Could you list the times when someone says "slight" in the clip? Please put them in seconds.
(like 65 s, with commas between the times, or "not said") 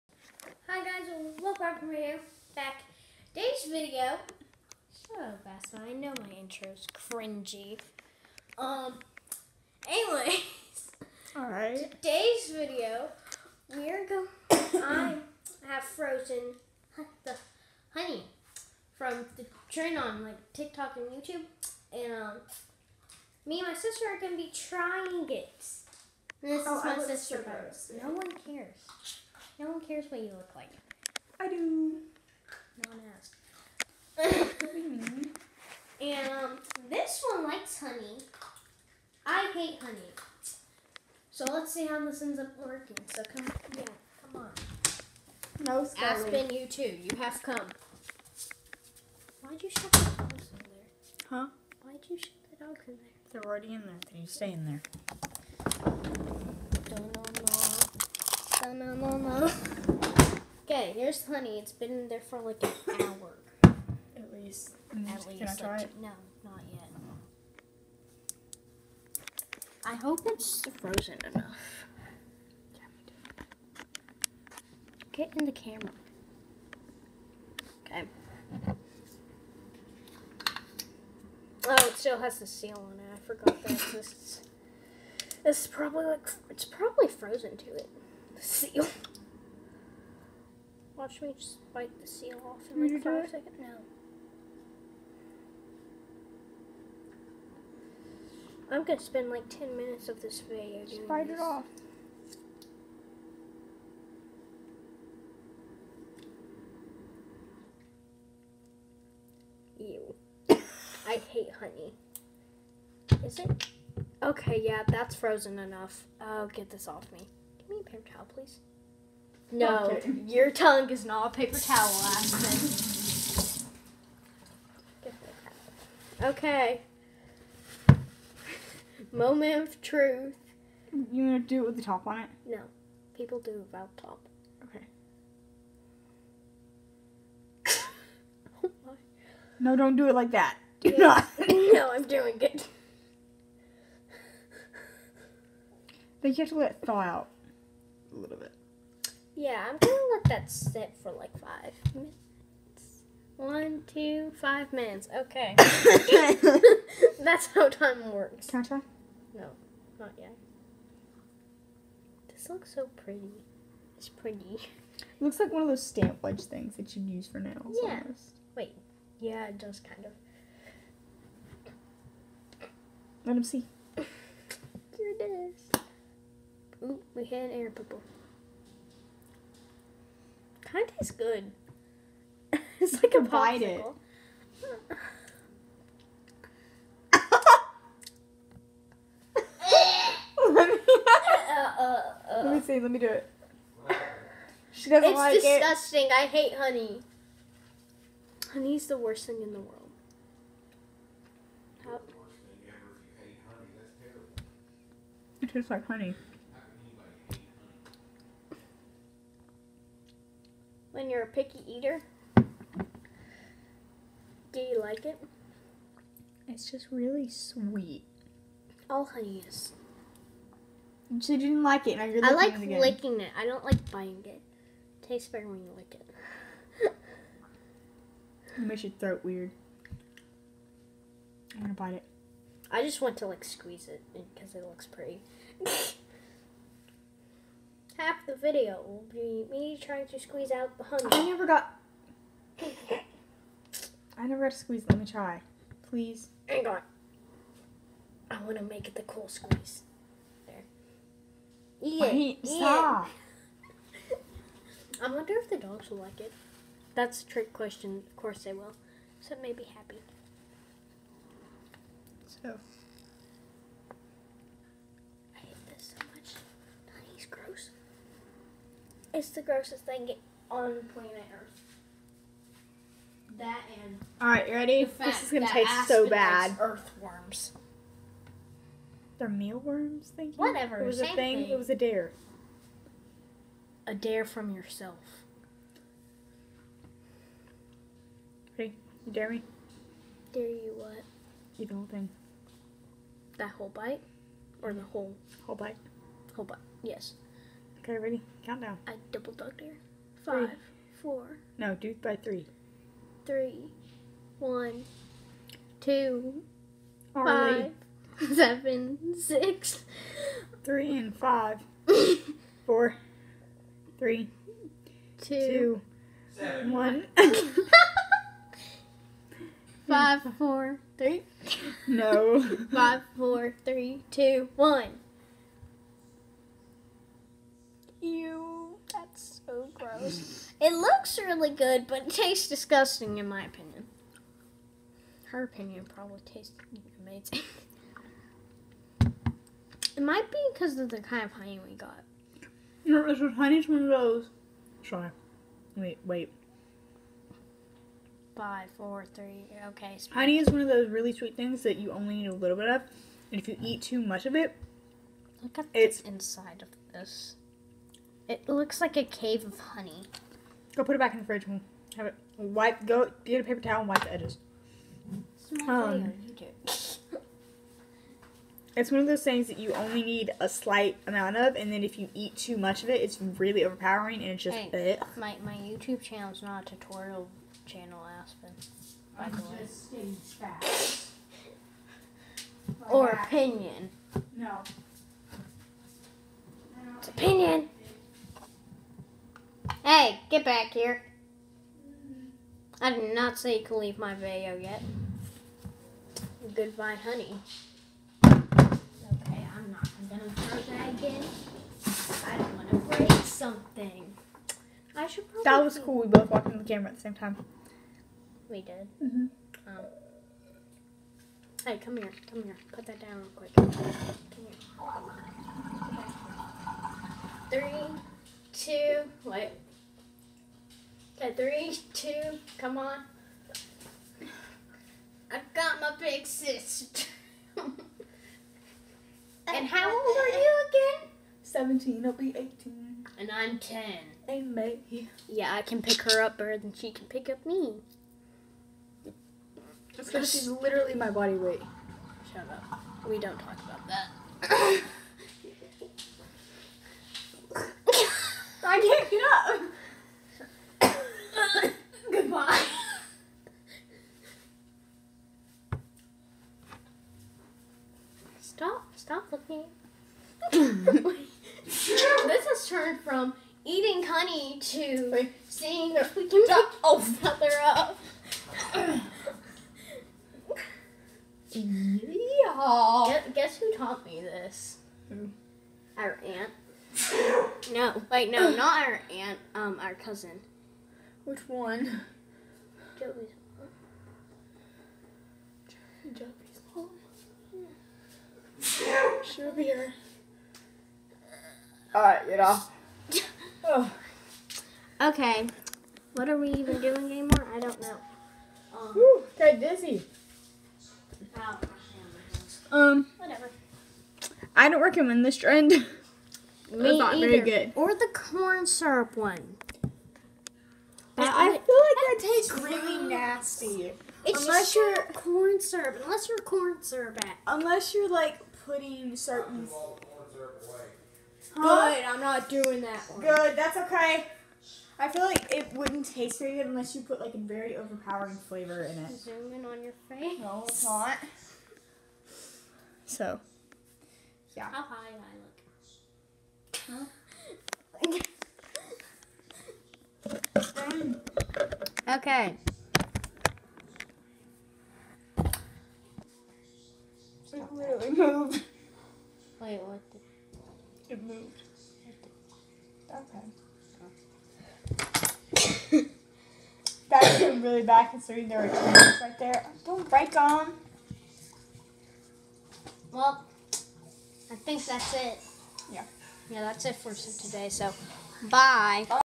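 370 s.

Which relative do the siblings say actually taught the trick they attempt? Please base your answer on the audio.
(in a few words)
cousin.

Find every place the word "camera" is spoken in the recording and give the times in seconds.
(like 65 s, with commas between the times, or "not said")
75 s, 406 s.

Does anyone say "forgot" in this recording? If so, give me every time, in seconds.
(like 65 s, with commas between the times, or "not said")
83 s.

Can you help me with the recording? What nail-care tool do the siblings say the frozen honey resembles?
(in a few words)
stamp.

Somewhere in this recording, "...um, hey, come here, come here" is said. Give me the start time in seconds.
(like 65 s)
409 s.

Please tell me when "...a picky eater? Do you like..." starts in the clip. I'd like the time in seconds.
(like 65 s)
211 s.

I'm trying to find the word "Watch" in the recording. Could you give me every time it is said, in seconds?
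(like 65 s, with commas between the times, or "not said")
91 s.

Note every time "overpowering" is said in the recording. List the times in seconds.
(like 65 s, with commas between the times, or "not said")
373 s, 527 s.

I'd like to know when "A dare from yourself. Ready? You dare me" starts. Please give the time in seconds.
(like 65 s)
283 s.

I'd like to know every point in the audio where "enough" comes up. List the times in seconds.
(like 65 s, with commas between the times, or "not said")
71 s, 115 s.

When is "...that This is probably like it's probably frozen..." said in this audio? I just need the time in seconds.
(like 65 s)
83 s.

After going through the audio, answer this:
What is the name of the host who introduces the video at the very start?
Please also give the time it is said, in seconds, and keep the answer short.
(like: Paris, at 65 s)
Parker, at 1 s.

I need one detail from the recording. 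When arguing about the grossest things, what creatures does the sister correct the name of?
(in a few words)
Mealworms.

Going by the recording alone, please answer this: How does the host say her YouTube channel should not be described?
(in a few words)
tutorial.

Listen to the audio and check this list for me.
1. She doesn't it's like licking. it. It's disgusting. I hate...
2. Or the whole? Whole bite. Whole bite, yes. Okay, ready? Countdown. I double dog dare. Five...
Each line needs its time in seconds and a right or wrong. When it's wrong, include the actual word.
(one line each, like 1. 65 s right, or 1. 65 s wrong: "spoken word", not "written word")
1. 194 s wrong: "disgusting", not "licking"
2. 294 s right.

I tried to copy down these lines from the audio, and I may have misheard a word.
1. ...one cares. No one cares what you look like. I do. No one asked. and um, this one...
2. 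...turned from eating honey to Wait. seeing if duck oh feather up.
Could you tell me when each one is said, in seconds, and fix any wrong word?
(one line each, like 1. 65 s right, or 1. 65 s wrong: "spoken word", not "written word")
1. 28 s right
2. 462 s right.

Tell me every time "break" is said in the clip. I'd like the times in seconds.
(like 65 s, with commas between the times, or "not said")
402 s, 560 s.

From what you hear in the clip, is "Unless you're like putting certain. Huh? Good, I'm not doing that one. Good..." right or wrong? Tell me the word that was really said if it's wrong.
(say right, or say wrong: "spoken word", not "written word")
right.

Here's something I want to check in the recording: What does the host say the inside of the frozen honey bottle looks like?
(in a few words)
a cave of honey.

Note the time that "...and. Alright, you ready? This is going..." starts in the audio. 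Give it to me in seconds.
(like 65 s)
273 s.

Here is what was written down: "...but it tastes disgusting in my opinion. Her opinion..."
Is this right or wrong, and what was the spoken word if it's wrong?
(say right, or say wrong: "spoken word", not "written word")
right.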